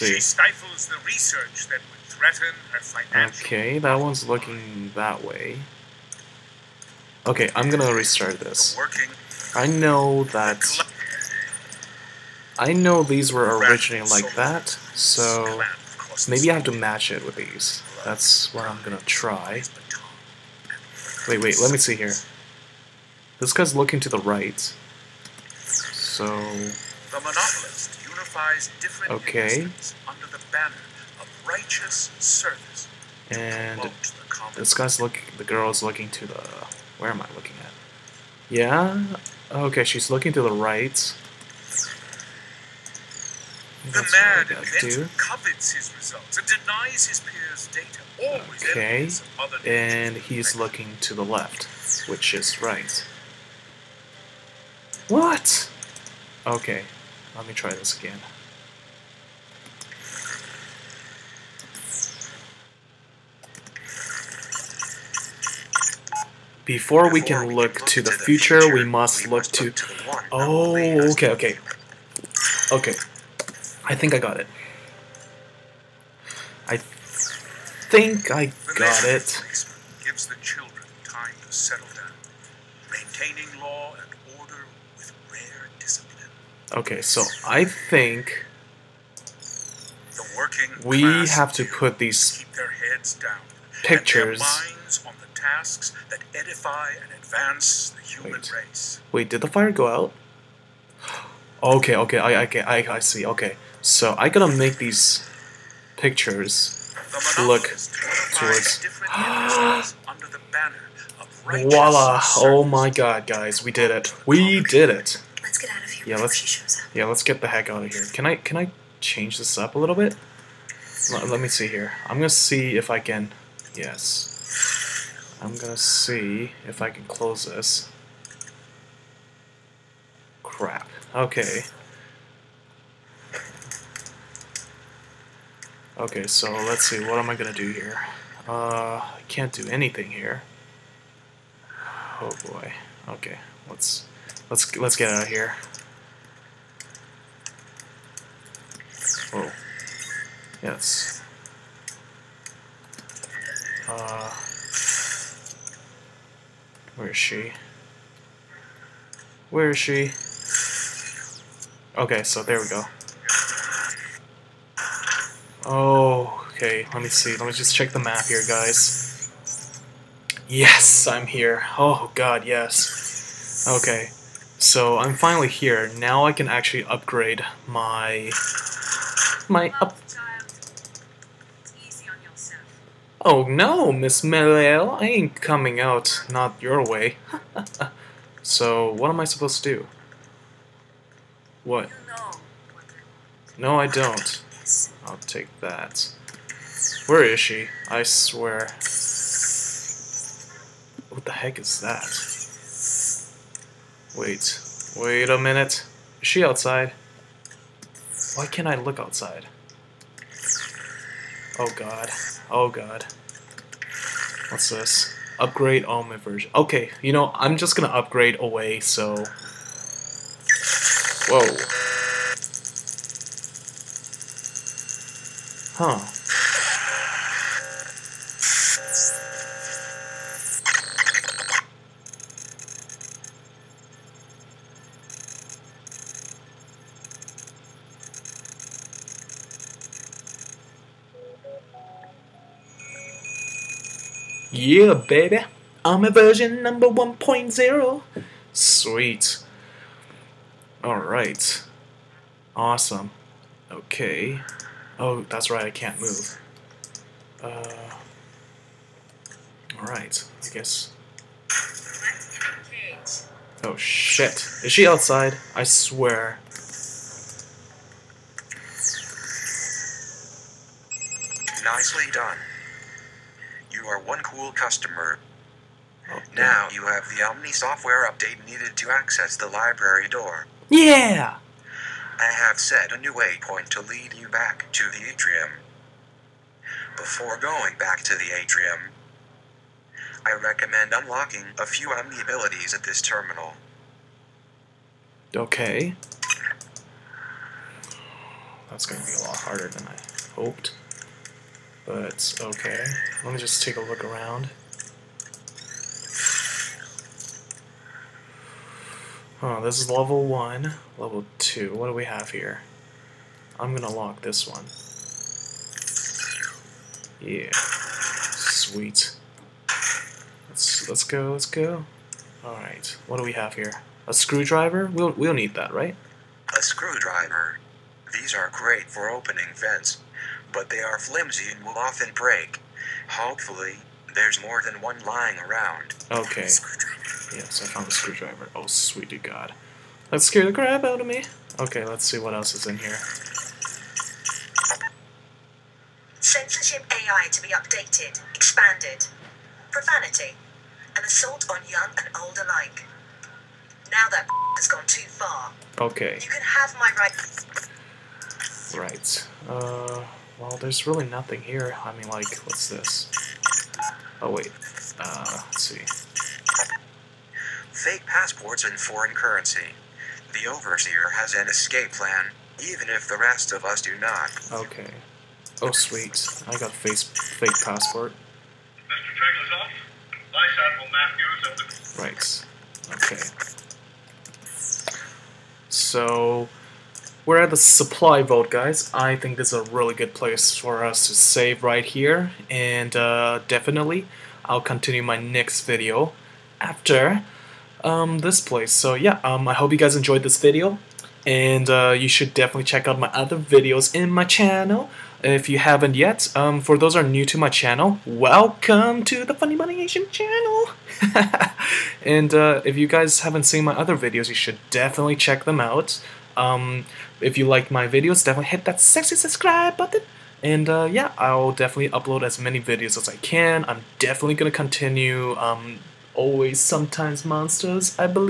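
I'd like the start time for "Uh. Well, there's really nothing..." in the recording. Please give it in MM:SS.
05:59.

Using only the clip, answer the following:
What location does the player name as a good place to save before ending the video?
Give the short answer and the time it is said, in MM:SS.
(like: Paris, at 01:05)
the supply vault, at 06:27.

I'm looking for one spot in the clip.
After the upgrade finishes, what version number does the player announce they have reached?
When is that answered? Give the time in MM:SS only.
04:06.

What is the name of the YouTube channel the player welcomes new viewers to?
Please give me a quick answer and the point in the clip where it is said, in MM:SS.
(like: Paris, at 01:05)
Funny Money Asian, at 06:49.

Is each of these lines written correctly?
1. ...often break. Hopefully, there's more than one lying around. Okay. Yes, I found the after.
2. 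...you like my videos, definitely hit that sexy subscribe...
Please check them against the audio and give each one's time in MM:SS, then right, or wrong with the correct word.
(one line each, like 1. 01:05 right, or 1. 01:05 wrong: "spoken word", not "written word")
1. 05:31 wrong: "screwdriver", not "after"
2. 06:57 right.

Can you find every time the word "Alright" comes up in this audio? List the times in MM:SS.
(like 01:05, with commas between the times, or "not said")
04:10, 04:19, 05:22.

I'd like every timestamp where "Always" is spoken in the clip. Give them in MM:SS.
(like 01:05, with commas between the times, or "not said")
00:48, 07:06.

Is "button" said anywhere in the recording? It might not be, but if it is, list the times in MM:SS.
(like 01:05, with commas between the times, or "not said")
06:59.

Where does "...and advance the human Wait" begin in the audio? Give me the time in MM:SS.
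01:37.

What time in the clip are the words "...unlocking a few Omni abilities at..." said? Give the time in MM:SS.
04:50.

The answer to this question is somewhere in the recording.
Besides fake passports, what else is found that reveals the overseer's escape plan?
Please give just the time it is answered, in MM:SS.
06:08.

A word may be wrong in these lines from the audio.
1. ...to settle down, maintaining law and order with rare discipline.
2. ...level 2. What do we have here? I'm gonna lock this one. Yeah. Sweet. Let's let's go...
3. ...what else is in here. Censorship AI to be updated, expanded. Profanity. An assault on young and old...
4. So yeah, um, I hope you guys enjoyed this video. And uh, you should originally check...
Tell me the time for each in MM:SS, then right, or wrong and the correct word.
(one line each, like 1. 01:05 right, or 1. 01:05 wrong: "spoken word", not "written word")
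1. 01:21 right
2. 05:10 right
3. 05:42 right
4. 06:38 wrong: "definitely", not "originally".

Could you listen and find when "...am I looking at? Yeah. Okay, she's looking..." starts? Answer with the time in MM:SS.
00:37.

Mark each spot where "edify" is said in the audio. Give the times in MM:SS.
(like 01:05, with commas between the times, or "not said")
01:36.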